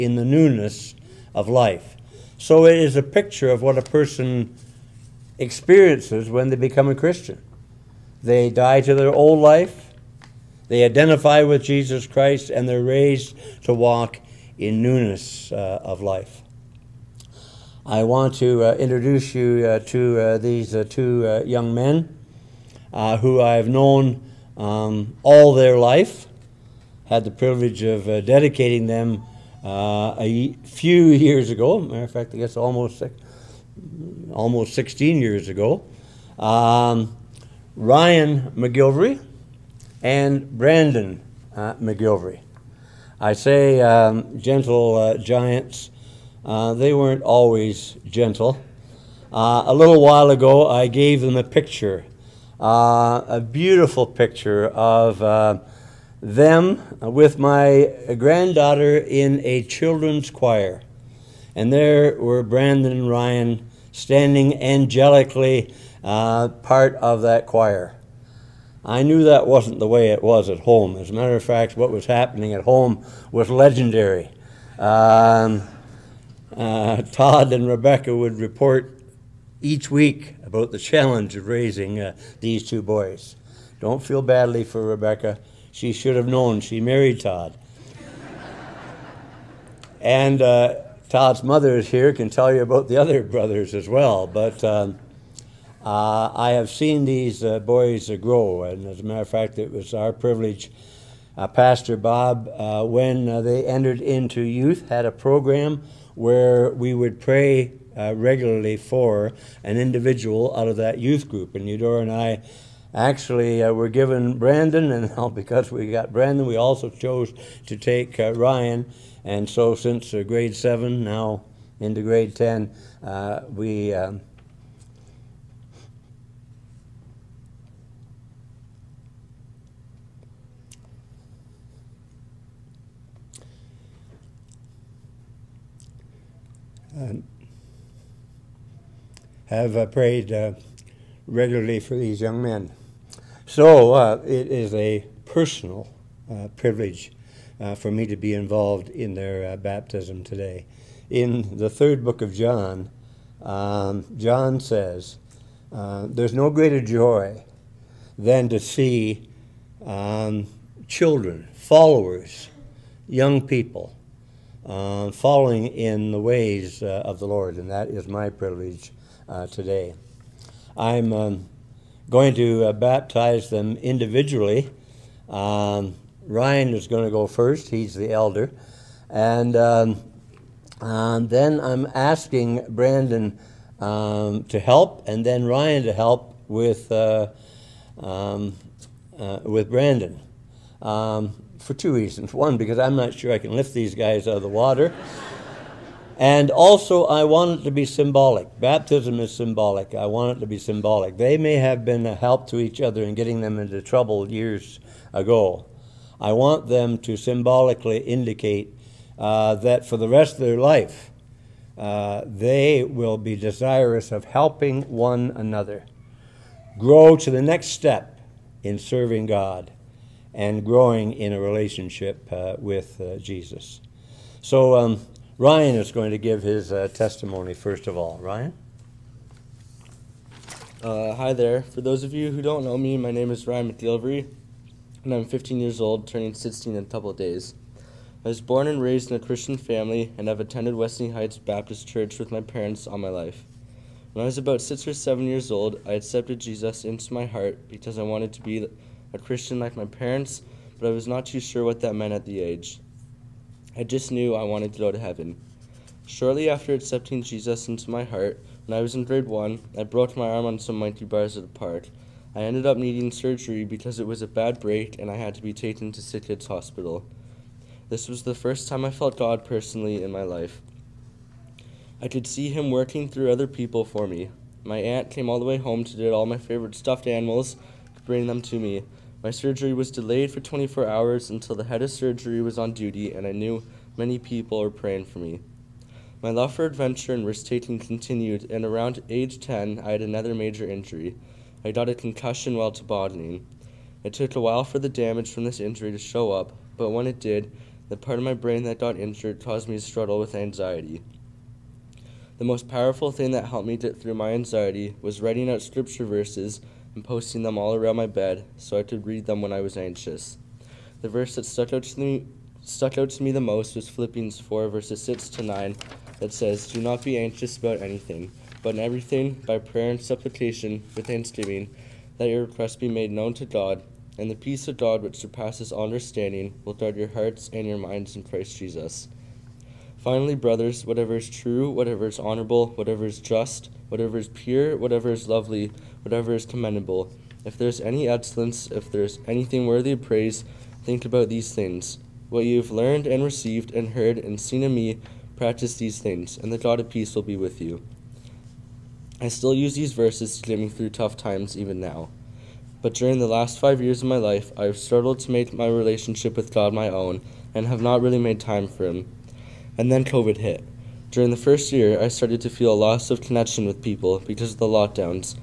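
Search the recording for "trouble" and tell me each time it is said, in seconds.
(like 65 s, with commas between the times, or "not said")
203 s.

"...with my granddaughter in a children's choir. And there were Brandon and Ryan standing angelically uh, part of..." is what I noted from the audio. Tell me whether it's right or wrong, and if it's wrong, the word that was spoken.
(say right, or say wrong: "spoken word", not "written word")
right.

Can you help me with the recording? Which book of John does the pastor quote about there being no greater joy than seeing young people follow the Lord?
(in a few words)
Third.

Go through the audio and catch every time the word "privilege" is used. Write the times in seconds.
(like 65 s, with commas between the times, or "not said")
27 s, 100 s, 146 s, 168 s.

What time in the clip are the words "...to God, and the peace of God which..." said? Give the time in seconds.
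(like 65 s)
323 s.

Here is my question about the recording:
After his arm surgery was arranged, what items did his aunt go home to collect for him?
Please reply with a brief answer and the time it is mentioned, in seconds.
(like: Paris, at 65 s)
Stuffed animals, at 276 s.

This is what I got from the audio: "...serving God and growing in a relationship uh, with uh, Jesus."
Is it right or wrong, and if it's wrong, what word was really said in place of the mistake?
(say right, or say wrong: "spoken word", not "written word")
right.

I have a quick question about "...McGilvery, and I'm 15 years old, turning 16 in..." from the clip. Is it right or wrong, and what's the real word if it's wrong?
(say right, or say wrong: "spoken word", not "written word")
right.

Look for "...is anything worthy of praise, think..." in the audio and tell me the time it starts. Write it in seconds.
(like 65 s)
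339 s.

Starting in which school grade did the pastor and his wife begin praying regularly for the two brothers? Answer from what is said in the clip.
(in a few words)
Grade 7.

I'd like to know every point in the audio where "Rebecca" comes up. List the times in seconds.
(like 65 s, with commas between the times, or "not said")
77 s, 84 s.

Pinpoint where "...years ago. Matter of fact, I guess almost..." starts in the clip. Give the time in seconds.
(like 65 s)
31 s.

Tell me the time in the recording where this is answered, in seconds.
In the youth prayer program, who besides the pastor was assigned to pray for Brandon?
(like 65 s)
111 s.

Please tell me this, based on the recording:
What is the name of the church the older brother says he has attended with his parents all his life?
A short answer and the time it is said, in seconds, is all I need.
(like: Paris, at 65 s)
Westney Heights Baptist Church, at 240 s.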